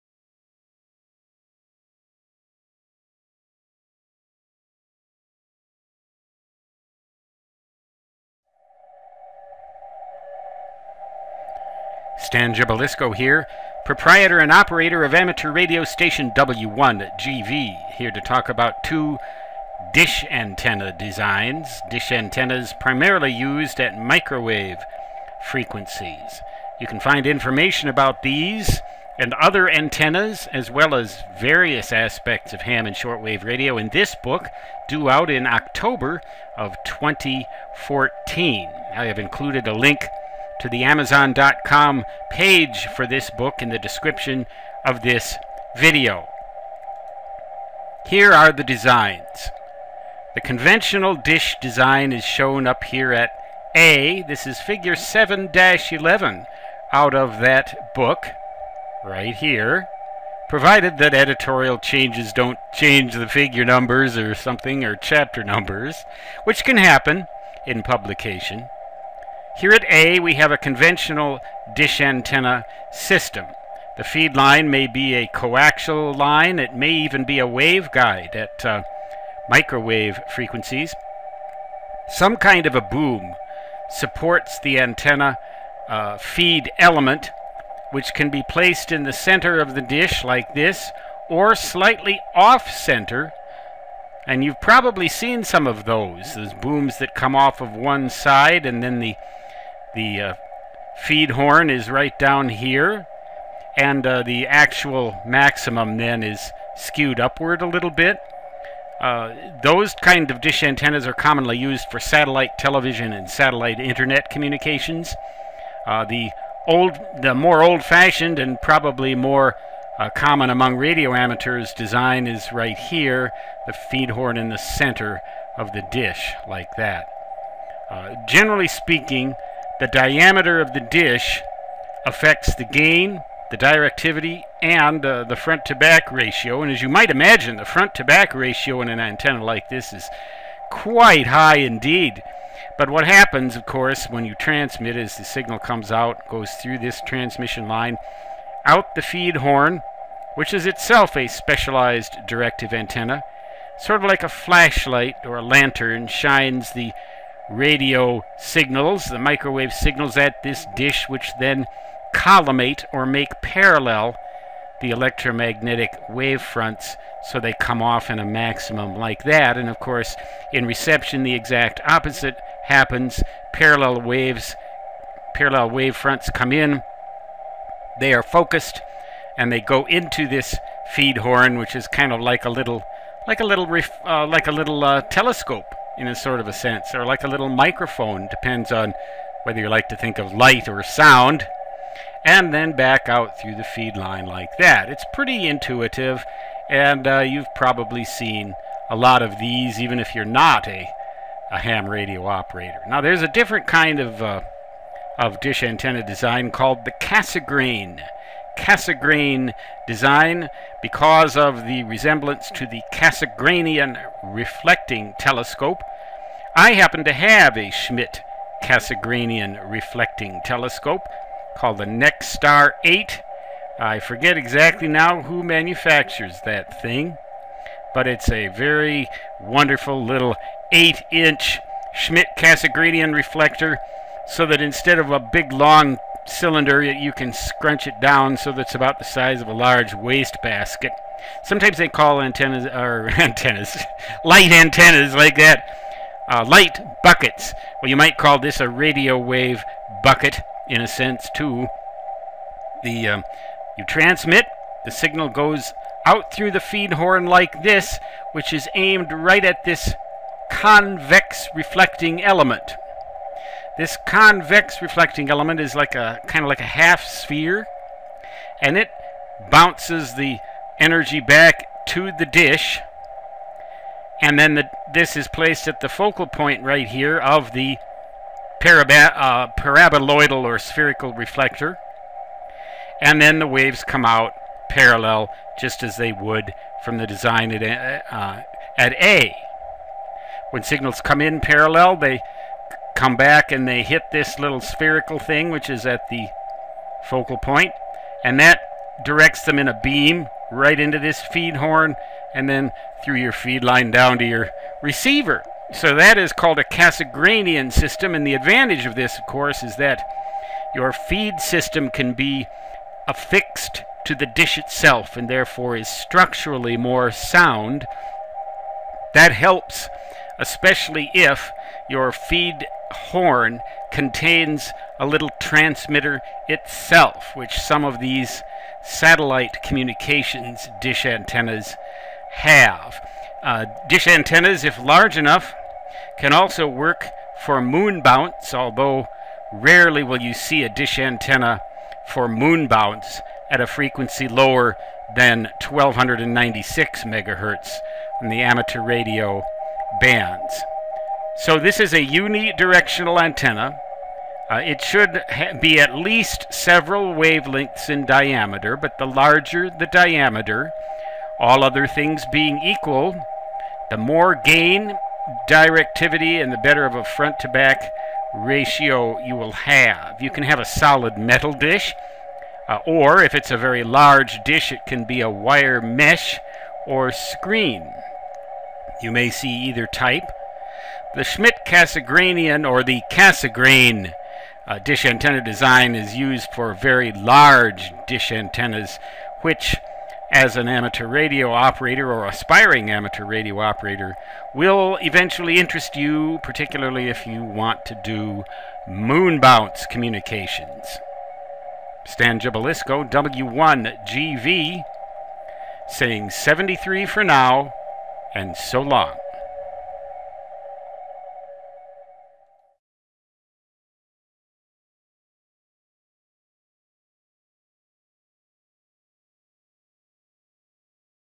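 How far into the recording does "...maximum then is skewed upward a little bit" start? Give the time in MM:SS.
01:45.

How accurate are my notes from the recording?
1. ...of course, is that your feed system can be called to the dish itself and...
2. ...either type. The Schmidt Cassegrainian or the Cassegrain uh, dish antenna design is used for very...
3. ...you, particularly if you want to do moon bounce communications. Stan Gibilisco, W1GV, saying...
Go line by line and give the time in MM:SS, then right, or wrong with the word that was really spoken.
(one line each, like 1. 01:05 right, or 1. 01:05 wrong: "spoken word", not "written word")
1. 05:09 wrong: "affixed", not "called"
2. 06:19 right
3. 06:35 right.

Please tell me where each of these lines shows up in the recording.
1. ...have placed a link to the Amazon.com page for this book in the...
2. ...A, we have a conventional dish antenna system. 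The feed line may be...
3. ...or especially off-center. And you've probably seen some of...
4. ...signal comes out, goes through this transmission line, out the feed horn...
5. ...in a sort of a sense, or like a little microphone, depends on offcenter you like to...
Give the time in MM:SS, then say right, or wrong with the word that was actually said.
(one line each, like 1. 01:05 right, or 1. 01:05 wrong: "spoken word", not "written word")
1. 00:39 wrong: "included", not "placed"
2. 01:09 right
3. 01:31 wrong: "slightly", not "especially"
4. 02:25 right
5. 03:06 wrong: "whether", not "offcenter".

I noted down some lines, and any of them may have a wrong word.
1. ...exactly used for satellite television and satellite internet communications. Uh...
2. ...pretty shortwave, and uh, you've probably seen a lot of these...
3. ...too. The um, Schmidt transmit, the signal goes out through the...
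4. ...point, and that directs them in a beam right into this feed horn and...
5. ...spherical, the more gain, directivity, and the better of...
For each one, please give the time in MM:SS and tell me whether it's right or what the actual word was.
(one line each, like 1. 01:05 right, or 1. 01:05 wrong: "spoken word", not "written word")
1. 01:51 wrong: "commonly", not "exactly"
2. 03:15 wrong: "intuitive", not "shortwave"
3. 04:11 wrong: "You", not "Schmidt"
4. 04:57 right
5. 06:02 wrong: "equal", not "spherical".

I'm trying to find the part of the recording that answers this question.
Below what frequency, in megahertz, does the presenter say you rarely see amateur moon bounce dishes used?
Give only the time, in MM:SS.
05:45.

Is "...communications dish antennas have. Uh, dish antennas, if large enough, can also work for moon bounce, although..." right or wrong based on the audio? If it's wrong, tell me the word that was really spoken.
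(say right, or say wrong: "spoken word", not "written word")
right.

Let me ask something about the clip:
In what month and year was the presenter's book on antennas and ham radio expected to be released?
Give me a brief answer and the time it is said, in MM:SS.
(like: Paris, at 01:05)
October 2014, at 00:35.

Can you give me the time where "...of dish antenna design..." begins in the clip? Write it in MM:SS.
03:25.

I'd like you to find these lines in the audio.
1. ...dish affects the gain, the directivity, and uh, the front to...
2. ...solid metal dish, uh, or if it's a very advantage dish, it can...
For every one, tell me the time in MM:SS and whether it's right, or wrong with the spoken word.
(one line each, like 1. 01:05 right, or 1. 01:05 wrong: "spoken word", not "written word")
1. 02:10 right
2. 06:10 wrong: "large", not "advantage".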